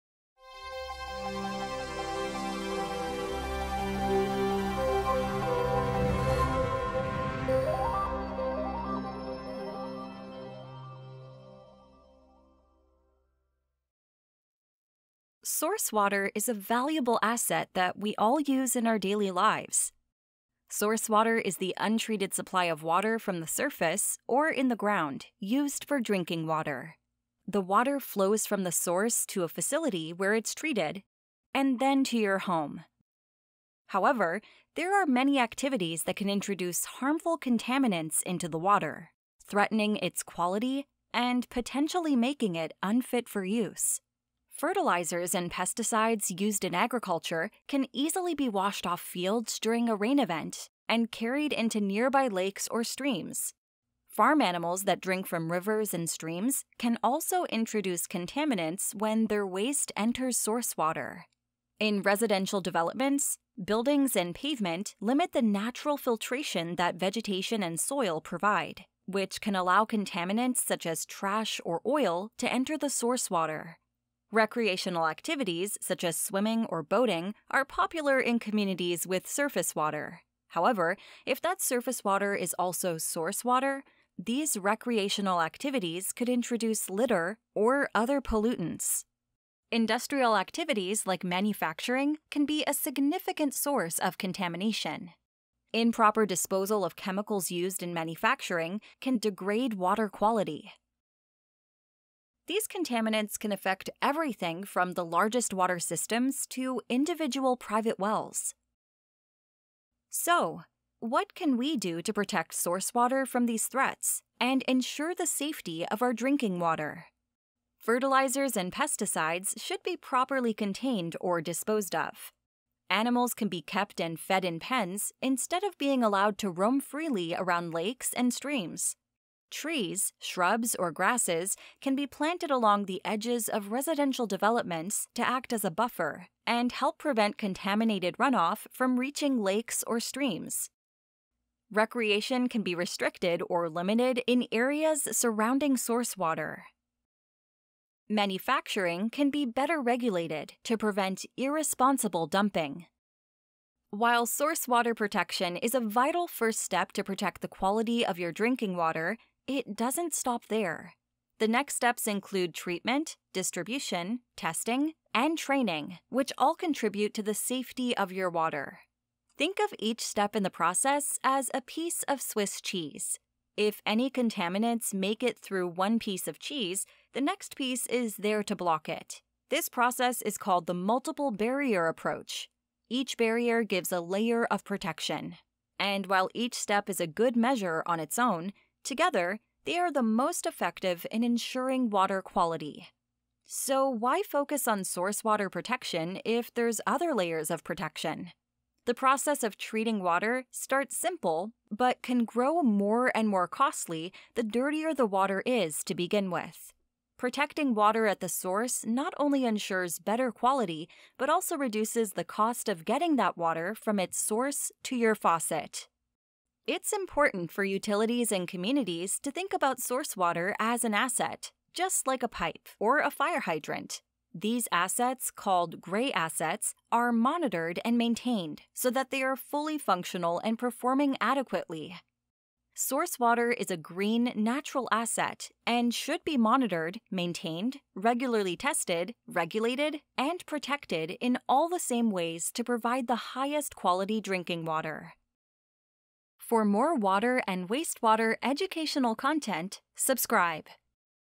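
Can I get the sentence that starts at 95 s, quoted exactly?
Improper disposal of chemicals used in manufacturing can degrade water quality.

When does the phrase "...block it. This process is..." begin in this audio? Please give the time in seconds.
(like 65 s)
178 s.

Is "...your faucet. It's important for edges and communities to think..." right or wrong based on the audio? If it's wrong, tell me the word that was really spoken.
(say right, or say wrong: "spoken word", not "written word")
wrong: "utilities", not "edges".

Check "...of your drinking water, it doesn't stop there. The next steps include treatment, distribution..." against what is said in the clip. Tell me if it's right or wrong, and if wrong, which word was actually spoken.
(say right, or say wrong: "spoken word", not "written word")
right.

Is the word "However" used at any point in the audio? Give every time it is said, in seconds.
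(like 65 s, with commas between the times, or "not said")
33 s, 80 s.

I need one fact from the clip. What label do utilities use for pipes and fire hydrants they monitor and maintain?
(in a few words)
gray assets.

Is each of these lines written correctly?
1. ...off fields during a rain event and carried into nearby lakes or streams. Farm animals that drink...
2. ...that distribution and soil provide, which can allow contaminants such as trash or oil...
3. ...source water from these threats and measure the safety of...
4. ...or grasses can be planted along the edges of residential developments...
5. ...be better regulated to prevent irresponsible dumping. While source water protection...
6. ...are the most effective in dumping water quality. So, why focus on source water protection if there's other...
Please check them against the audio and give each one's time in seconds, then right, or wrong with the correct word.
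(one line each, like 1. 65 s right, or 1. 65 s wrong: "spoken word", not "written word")
1. 48 s right
2. 66 s wrong: "vegetation", not "distribution"
3. 112 s wrong: "ensure", not "measure"
4. 130 s right
5. 149 s right
6. 189 s wrong: "ensuring", not "dumping".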